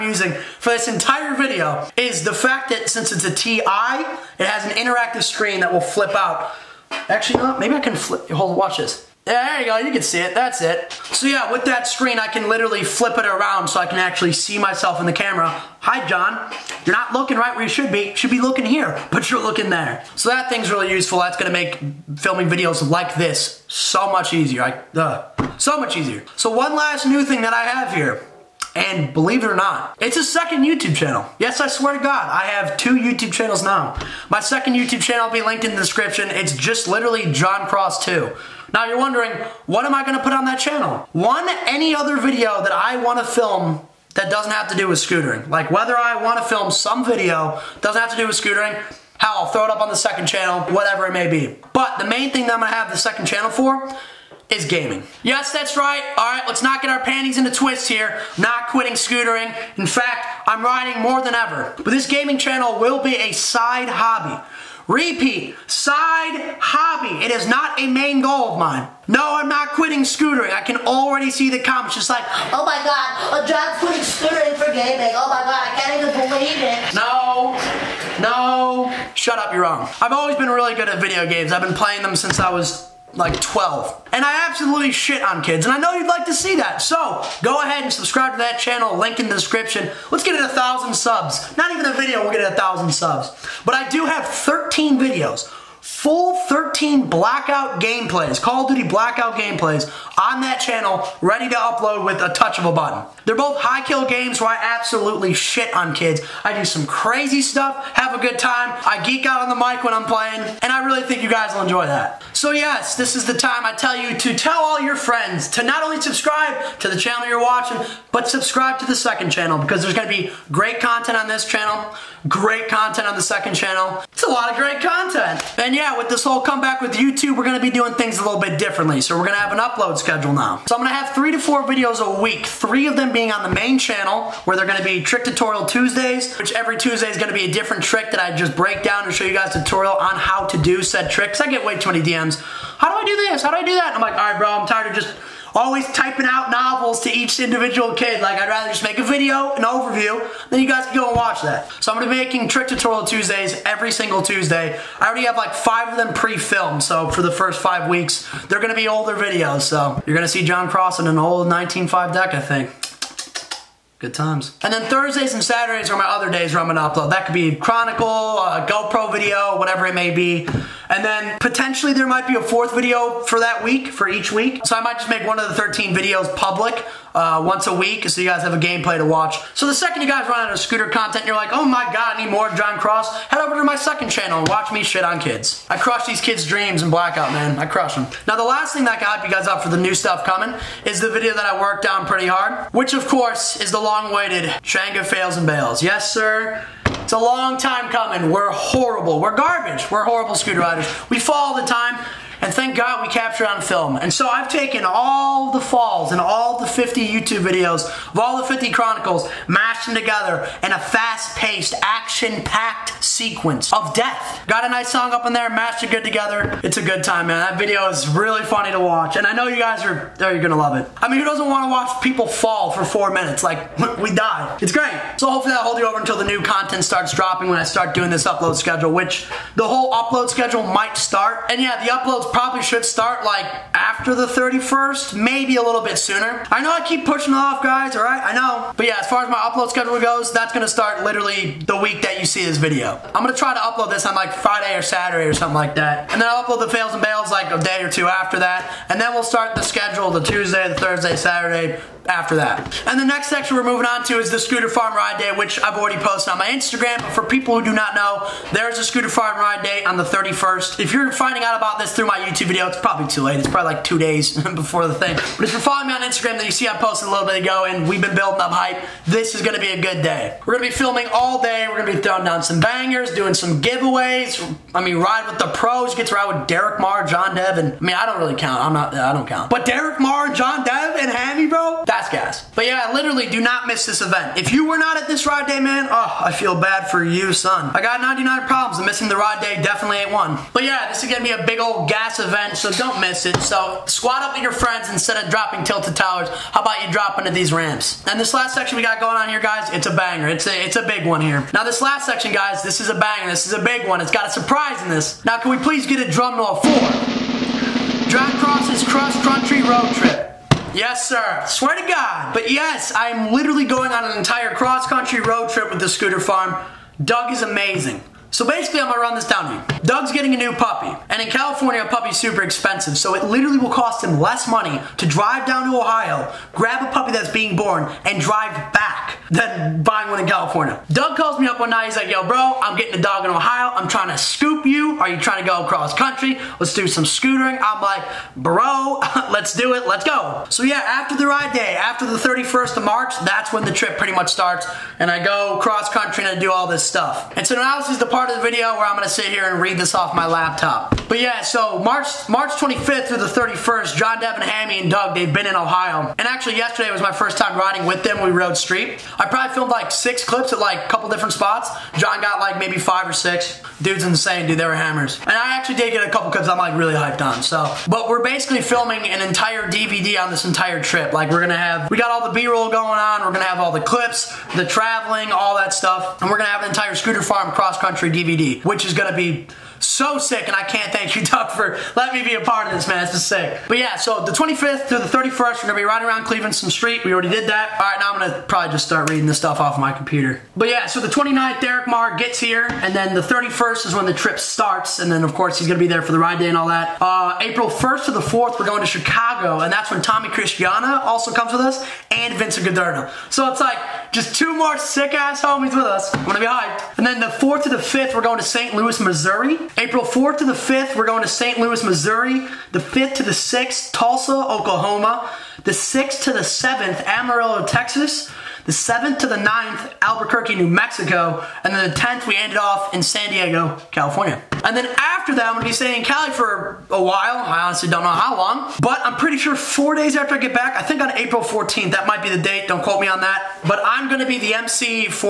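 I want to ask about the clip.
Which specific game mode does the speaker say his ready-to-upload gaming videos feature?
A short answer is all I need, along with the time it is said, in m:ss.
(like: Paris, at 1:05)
Call of Duty Blackout, at 1:38.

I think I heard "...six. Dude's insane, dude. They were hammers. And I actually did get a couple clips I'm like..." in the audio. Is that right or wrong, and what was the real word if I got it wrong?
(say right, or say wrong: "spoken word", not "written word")
right.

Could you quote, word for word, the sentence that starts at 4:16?
But for people who do not know, there's a Scooter Farm Ride Day on the 31st.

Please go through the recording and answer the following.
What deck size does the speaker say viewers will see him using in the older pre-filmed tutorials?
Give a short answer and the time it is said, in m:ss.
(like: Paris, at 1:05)
19.5, at 2:41.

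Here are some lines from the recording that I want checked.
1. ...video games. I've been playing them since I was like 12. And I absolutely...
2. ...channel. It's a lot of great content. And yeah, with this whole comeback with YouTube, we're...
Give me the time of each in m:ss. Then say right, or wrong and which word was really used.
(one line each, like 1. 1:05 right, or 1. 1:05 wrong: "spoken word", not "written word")
1. 1:21 right
2. 2:03 right.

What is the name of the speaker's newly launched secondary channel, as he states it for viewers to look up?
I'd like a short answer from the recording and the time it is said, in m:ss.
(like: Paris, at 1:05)
Jon Cross 2, at 0:37.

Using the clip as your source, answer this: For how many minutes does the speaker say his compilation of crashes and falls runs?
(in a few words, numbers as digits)
4.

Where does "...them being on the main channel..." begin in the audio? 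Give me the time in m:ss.
2:12.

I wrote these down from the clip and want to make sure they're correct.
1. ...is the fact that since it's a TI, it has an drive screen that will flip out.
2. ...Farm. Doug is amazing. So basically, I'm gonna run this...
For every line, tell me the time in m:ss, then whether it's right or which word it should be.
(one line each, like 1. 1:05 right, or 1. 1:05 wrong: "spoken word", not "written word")
1. 0:01 wrong: "interactive", not "drive"
2. 5:16 right.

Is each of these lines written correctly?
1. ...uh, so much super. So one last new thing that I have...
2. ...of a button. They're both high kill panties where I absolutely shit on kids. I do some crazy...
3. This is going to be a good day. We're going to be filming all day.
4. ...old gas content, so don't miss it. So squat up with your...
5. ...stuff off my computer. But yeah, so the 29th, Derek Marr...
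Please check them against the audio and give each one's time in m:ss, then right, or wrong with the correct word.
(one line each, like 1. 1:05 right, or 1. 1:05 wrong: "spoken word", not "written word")
1. 0:24 wrong: "easier", not "super"
2. 1:42 wrong: "games", not "panties"
3. 4:29 right
4. 4:51 wrong: "event", not "content"
5. 6:29 right.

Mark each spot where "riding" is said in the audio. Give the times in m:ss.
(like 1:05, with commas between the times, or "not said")
1:00, 5:57, 6:25.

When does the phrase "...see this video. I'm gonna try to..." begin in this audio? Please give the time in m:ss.
4:02.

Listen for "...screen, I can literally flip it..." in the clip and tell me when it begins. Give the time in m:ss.
0:11.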